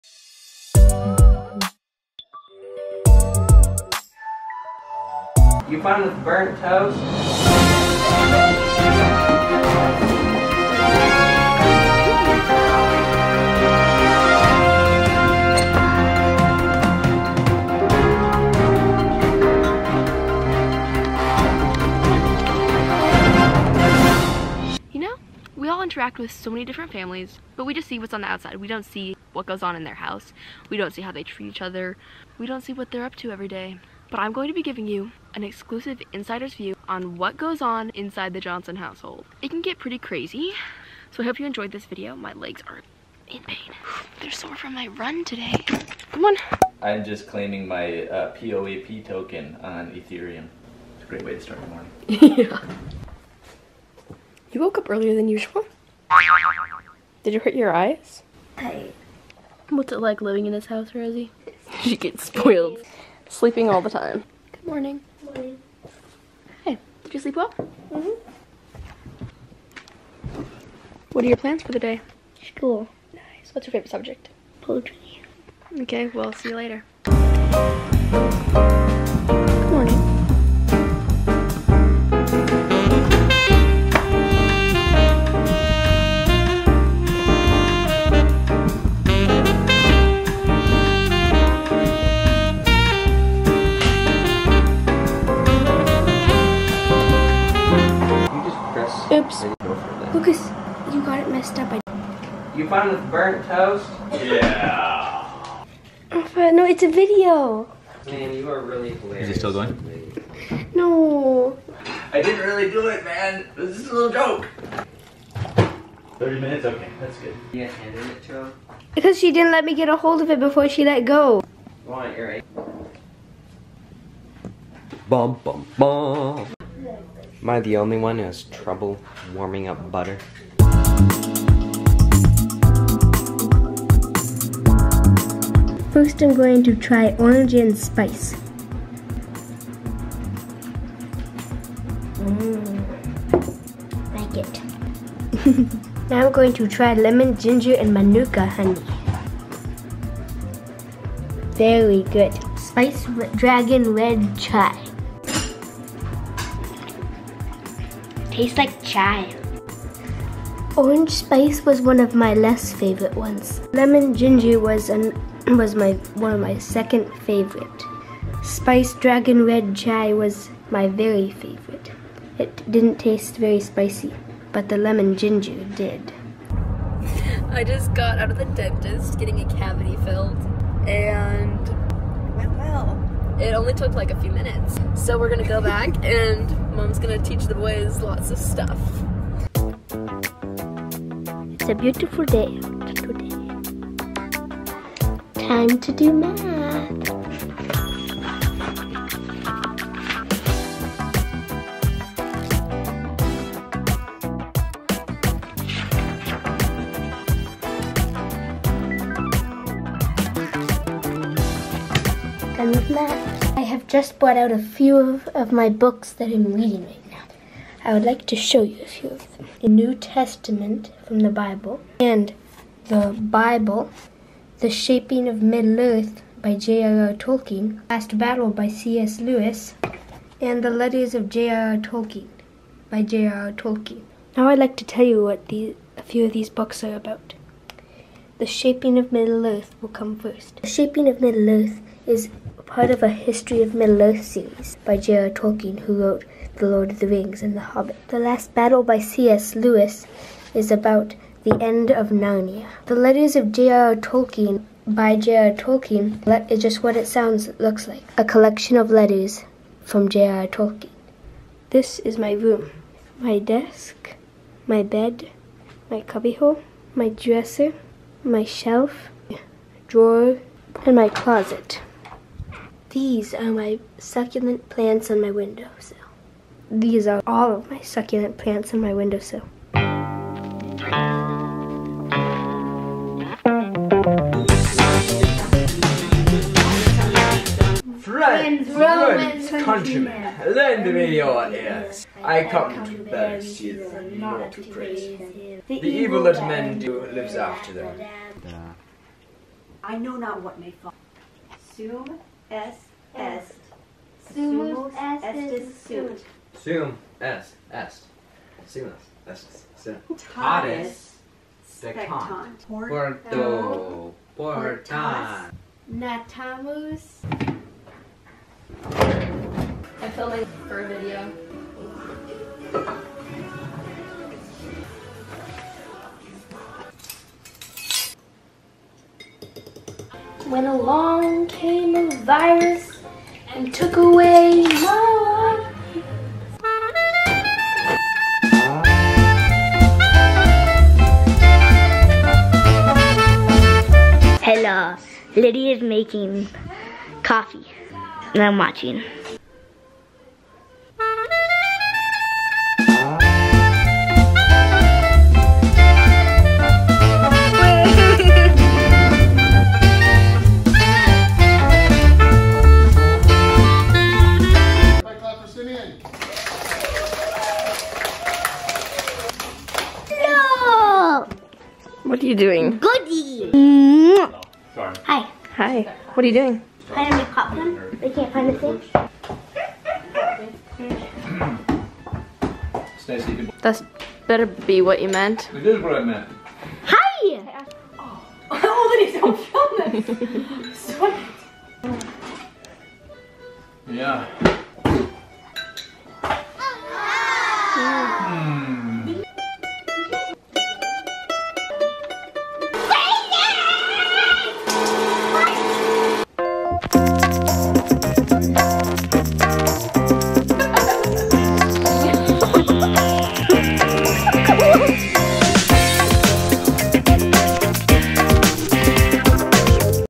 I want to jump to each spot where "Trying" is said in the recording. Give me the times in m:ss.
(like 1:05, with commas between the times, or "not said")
6:16.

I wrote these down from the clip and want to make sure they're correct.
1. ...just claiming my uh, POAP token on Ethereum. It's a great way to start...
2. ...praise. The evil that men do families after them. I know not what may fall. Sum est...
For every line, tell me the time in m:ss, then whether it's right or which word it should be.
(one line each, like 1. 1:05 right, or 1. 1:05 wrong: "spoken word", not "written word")
1. 0:47 right
2. 4:54 wrong: "lives", not "families".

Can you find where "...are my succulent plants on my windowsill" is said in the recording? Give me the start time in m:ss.
4:33.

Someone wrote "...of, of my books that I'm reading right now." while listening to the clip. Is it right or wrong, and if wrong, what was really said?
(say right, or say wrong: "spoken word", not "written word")
right.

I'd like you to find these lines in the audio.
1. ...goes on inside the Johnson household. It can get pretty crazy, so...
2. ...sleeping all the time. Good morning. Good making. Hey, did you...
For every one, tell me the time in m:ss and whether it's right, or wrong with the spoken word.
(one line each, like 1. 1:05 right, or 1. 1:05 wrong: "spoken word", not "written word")
1. 0:37 right
2. 1:03 wrong: "morning", not "making".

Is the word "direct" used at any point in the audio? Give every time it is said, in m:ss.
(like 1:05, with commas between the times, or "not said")
not said.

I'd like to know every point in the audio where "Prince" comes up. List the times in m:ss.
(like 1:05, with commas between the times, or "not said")
not said.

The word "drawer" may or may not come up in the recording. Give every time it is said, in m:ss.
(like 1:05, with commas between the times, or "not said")
4:29.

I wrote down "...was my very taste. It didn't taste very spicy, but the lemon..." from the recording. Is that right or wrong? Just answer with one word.
wrong.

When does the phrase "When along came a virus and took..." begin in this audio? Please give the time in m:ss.
5:30.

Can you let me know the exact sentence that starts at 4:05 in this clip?
Tolkien, who wrote The Lord of the Rings and The Hobbit.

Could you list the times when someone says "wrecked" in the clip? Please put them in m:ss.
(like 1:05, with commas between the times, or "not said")
not said.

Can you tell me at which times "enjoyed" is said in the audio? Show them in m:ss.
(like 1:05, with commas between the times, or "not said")
0:41.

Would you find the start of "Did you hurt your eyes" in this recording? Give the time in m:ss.
0:57.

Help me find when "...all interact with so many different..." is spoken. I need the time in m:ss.
0:25.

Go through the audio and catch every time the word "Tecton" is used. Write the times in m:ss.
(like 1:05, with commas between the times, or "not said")
5:11.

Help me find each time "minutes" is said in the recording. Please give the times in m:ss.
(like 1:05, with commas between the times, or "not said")
1:56, 3:04.